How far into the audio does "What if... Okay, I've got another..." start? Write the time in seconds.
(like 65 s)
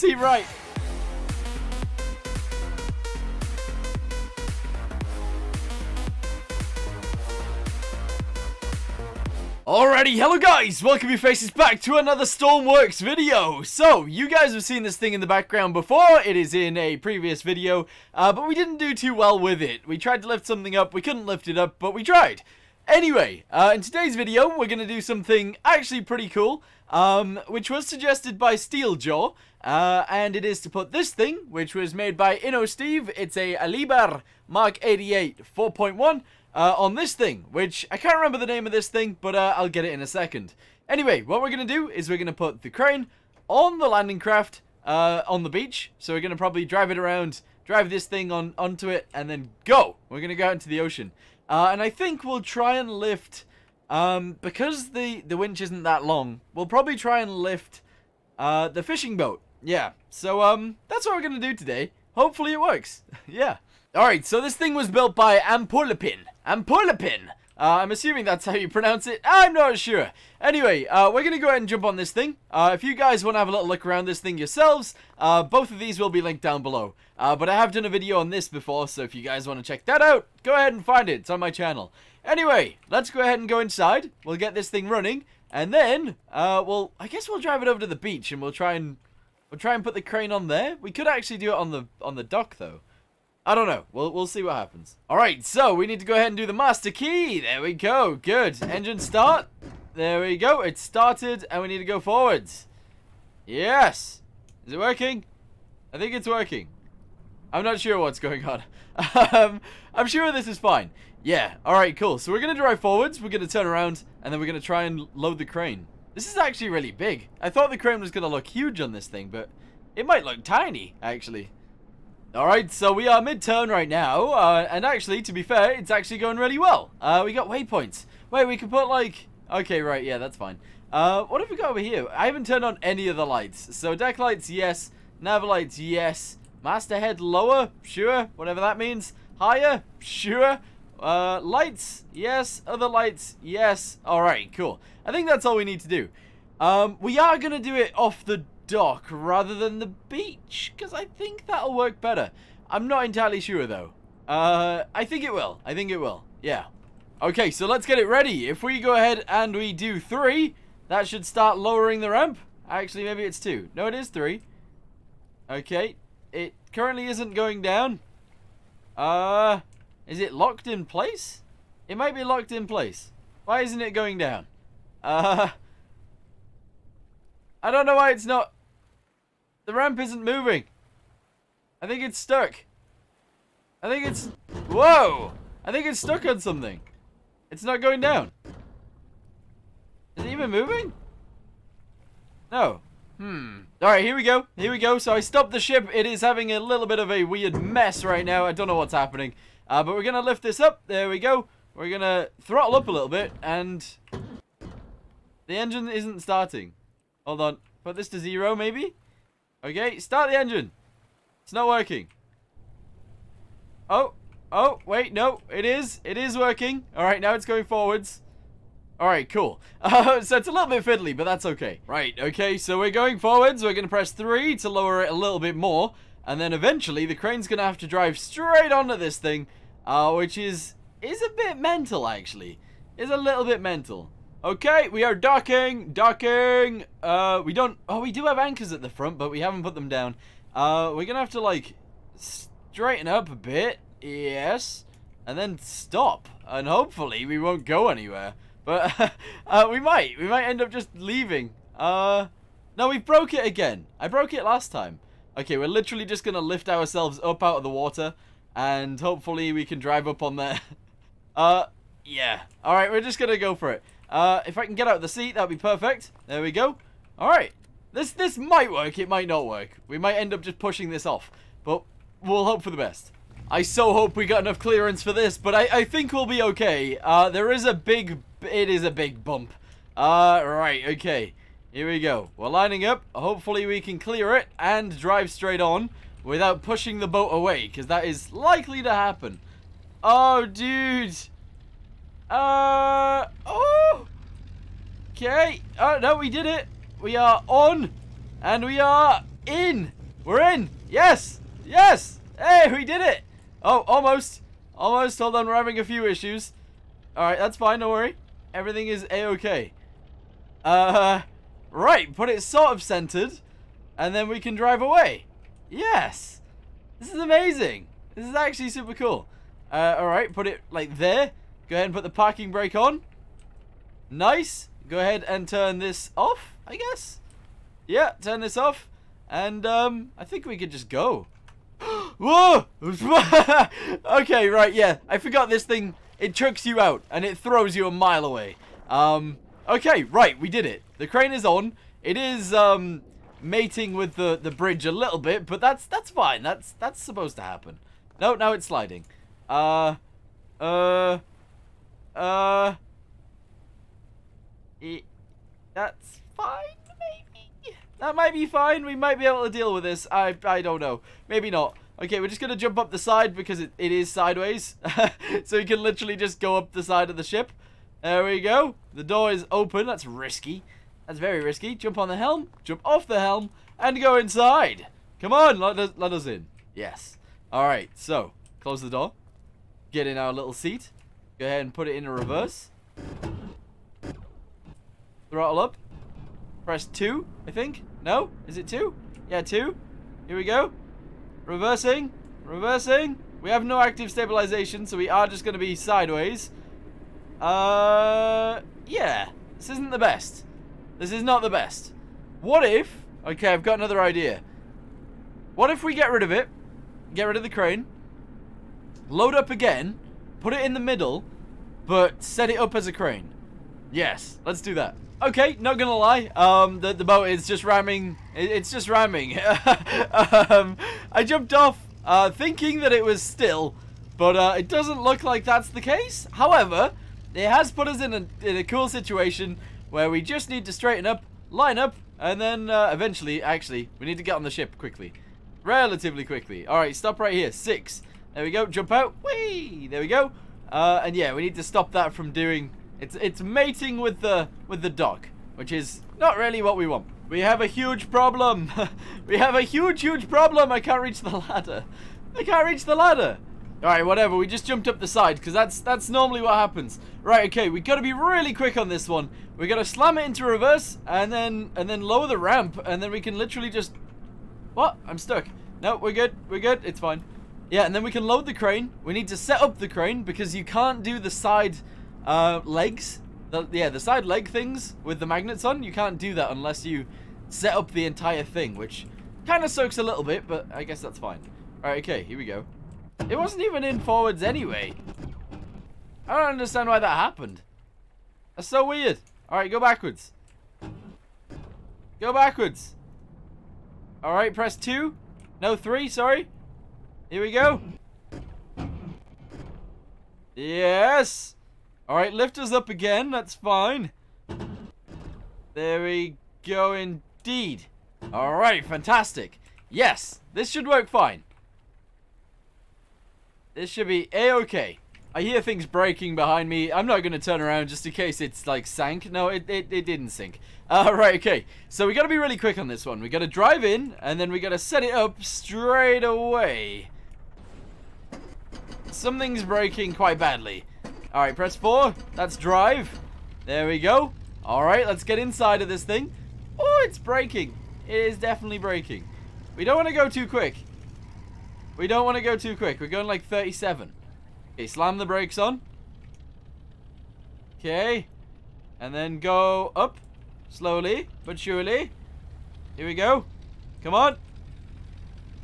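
402 s.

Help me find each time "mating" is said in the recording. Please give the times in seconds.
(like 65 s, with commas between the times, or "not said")
343 s, 443 s.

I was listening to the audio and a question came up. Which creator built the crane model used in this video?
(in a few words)
Inno Steve.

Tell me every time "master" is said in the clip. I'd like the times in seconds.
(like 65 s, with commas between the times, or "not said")
96 s, 136 s.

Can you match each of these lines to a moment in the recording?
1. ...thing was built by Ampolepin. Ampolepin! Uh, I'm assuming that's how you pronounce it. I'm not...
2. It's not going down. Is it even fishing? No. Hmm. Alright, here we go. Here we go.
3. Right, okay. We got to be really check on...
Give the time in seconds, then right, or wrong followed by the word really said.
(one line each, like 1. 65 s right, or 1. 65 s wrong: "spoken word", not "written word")
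1. 64 s right
2. 187 s wrong: "moving", not "fishing"
3. 457 s wrong: "quick", not "check".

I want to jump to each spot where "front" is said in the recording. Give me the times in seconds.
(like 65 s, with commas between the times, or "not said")
238 s.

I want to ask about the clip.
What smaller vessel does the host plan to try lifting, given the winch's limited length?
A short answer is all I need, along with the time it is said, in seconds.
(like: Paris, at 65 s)
the fishing boat, at 58 s.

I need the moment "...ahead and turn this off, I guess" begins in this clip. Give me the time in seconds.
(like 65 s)
324 s.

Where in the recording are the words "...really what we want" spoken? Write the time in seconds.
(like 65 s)
446 s.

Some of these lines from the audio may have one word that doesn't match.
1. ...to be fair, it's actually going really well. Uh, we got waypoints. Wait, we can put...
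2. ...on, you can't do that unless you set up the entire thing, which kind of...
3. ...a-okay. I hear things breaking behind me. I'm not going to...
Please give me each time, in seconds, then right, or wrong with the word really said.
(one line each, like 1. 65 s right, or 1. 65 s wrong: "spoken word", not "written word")
1. 125 s right
2. 475 s right
3. 514 s right.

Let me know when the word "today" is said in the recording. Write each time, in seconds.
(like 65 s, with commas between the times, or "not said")
23 s, 61 s.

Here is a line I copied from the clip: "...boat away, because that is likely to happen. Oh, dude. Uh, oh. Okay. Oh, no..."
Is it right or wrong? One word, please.
right.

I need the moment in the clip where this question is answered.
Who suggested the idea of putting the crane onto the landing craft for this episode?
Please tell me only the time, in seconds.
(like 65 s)
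28 s.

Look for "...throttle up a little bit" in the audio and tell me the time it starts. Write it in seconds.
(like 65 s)
202 s.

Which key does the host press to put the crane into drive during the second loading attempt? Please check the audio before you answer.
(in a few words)
4.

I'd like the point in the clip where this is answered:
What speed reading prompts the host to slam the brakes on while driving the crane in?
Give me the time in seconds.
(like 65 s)
543 s.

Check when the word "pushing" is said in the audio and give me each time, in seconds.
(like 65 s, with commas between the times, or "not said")
270 s, 286 s.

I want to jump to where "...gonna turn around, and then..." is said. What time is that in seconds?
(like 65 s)
113 s.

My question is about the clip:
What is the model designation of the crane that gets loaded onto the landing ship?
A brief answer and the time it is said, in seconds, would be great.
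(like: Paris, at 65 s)
Liebherr Mark 88 4.1, at 33 s.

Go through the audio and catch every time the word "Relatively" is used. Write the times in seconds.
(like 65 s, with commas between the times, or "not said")
435 s.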